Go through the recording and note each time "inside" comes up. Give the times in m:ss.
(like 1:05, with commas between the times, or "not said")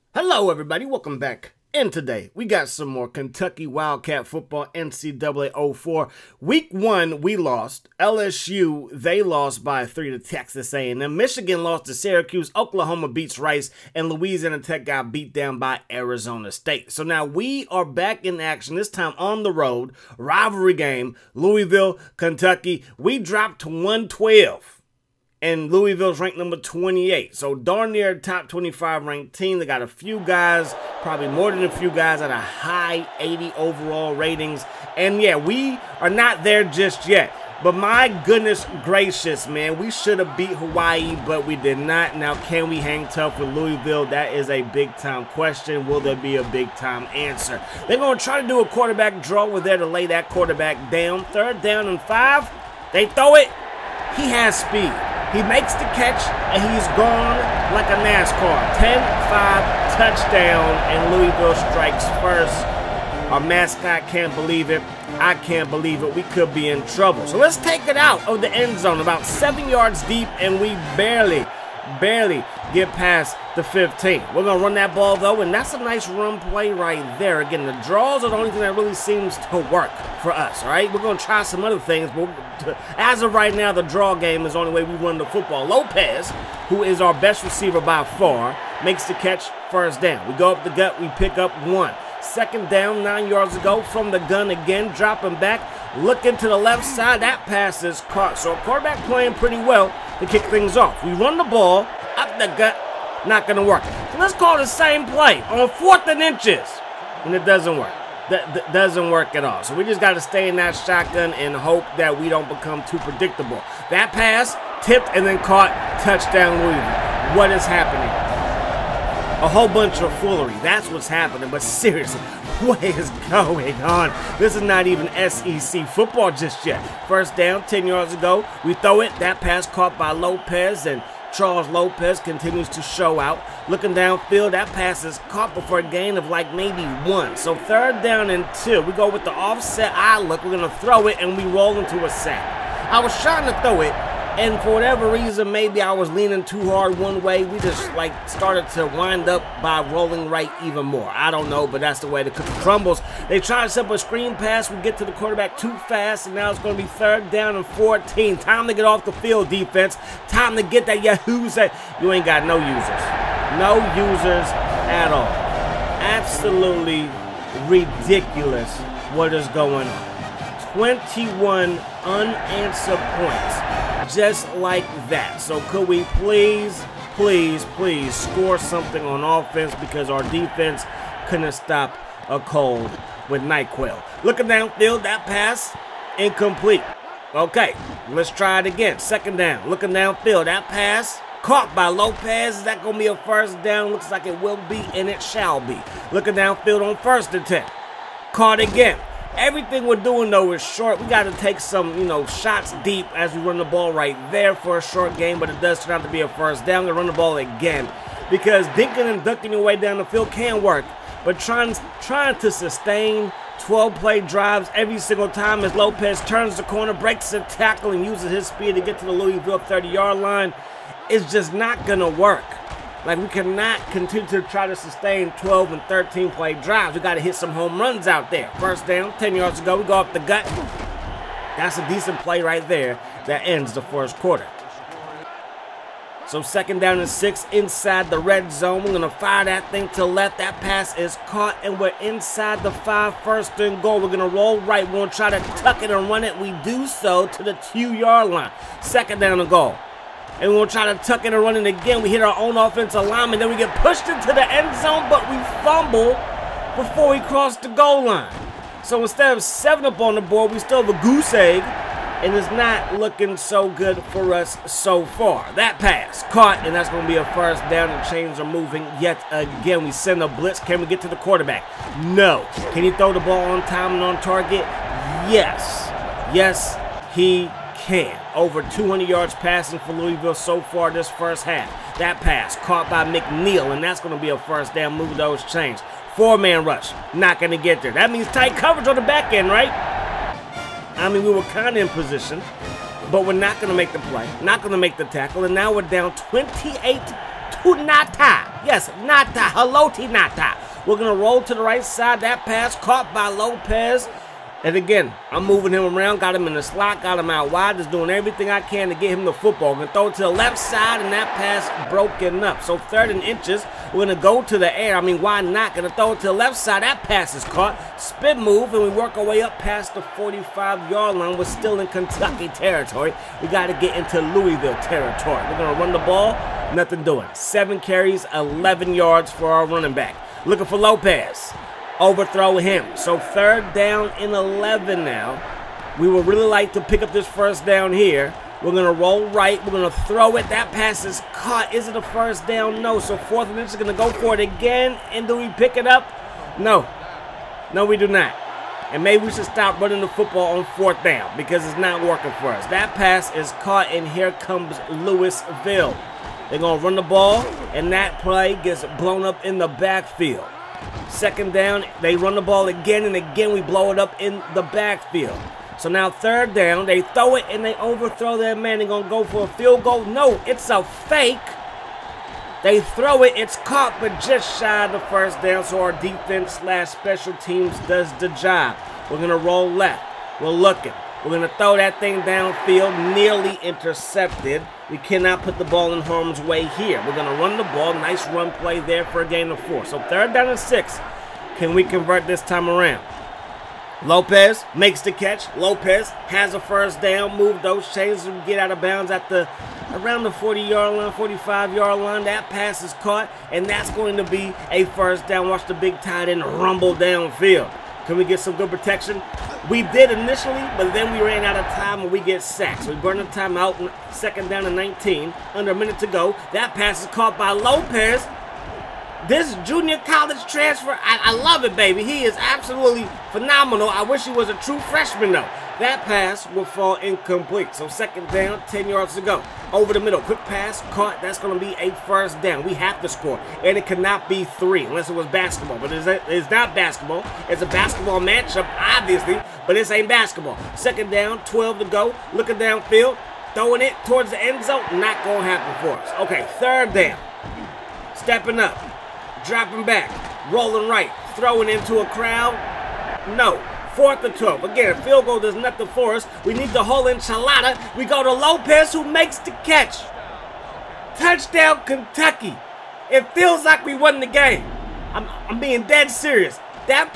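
3:57, 4:02.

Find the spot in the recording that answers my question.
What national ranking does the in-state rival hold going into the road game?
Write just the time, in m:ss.
0:26.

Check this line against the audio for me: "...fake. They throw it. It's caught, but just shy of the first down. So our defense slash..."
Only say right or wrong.
right.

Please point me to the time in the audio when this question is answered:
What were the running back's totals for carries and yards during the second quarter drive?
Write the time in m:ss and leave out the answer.
5:27.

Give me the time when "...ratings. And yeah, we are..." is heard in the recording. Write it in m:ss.
0:34.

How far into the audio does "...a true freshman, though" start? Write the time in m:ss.
7:04.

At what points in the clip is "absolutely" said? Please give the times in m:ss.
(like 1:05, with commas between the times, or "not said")
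2:46, 7:02.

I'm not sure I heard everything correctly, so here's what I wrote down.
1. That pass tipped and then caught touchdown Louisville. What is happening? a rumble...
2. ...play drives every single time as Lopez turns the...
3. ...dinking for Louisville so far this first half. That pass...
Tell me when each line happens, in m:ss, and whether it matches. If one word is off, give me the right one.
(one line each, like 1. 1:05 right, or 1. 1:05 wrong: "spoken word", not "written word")
1. 1:53 wrong: "whole", not "rumble"
2. 3:33 right
3. 4:39 wrong: "passing", not "dinking".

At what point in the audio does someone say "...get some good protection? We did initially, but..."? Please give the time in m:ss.
6:48.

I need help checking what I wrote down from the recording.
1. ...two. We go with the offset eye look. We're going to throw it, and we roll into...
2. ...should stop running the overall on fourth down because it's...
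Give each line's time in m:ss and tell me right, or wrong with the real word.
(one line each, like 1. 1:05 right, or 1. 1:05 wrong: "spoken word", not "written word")
1. 2:18 right
2. 5:49 wrong: "football", not "overall".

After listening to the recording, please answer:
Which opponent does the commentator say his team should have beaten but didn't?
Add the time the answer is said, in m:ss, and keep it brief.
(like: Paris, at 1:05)
Hawaii, at 0:40.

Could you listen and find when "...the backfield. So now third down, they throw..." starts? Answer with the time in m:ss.
6:04.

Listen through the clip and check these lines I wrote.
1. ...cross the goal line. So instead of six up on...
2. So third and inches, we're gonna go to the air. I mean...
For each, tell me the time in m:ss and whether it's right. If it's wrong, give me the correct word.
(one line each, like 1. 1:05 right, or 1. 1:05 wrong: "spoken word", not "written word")
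1. 4:17 wrong: "seven", not "six"
2. 5:12 right.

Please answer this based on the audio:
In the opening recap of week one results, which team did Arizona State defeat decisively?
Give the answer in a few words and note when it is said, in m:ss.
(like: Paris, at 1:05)
Louisiana Tech, at 0:14.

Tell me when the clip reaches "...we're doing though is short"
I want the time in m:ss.
3:19.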